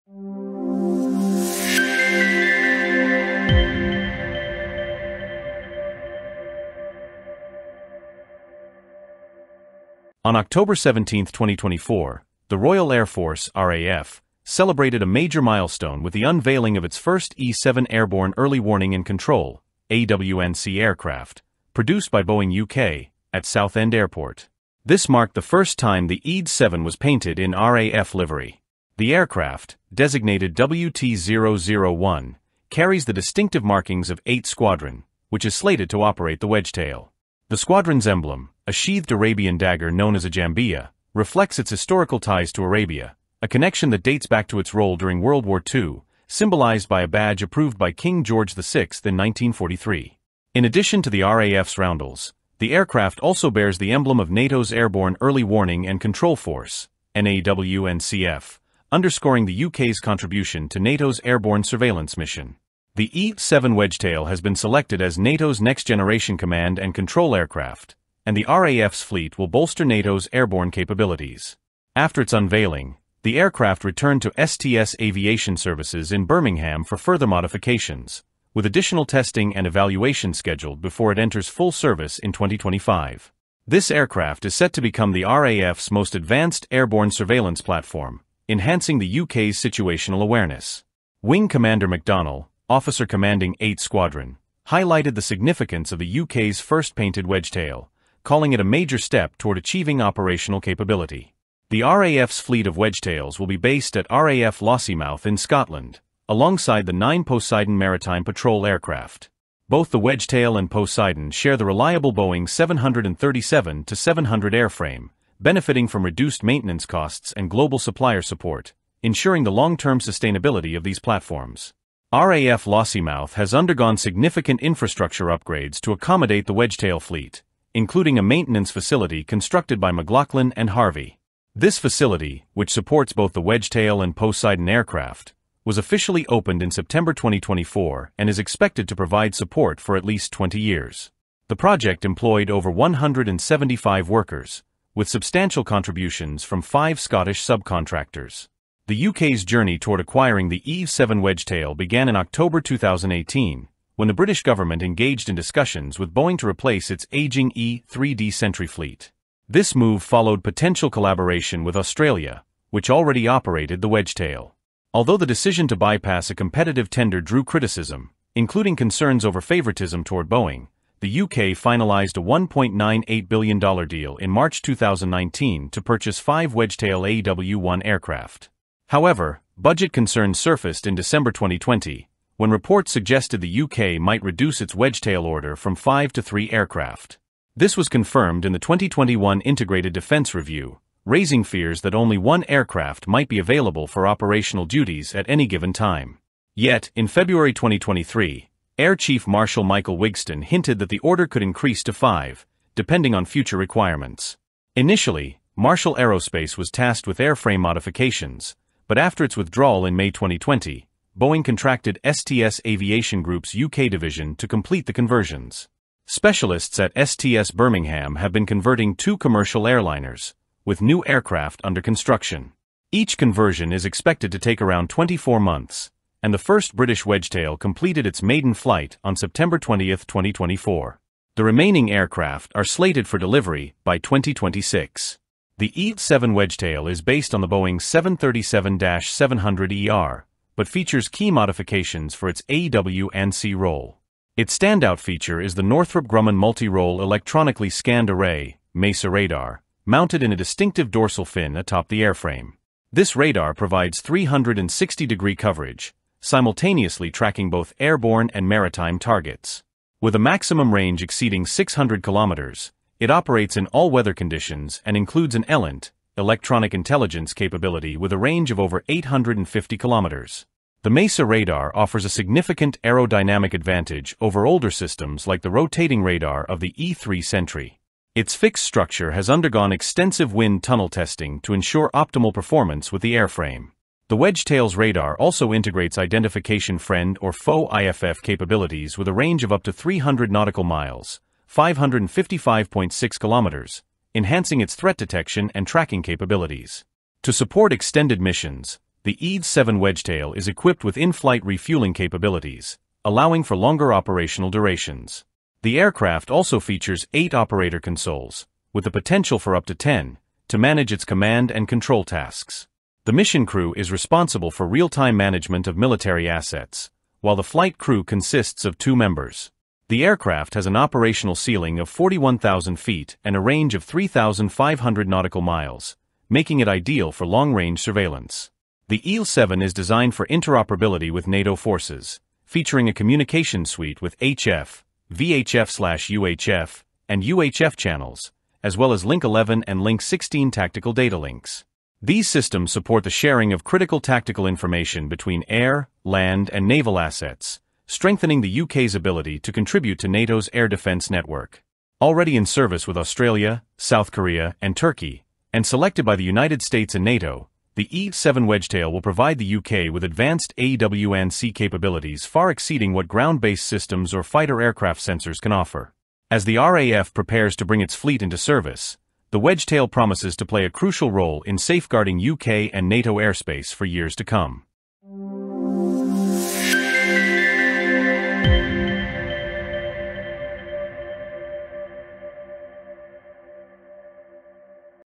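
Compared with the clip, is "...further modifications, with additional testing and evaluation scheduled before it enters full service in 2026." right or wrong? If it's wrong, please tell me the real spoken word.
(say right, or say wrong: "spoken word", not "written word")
wrong: "2025", not "2026".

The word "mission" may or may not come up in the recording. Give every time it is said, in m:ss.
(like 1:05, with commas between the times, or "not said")
1:02, 4:58, 5:13.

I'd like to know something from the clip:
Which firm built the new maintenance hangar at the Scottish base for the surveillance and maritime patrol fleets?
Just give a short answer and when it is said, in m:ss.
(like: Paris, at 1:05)
McLaughlin and Harvey, at 2:09.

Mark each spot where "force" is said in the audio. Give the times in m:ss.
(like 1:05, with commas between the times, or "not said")
0:13, 0:56, 5:31.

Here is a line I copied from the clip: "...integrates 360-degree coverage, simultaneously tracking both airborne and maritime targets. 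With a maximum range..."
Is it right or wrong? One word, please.
wrong.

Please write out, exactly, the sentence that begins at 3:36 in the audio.
Specialists at STS Birmingham have been converting two commercial airliners, with new aircraft under construction.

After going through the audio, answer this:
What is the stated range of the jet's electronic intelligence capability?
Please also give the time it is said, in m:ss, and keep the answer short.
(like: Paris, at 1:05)
850 kilometers, at 4:28.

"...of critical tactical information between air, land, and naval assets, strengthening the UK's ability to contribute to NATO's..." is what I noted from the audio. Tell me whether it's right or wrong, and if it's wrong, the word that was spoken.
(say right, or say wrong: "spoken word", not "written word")
right.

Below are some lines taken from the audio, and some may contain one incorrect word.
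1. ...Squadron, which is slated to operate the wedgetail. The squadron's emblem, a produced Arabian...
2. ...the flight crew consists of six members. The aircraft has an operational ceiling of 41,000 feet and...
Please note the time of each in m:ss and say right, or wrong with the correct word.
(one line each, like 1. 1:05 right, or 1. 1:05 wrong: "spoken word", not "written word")
1. 0:34 wrong: "sheathed", not "produced"
2. 5:17 wrong: "two", not "six".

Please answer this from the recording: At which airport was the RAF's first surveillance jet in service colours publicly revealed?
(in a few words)
Southend Airport.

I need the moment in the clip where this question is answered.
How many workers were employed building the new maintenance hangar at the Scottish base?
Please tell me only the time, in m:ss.
2:22.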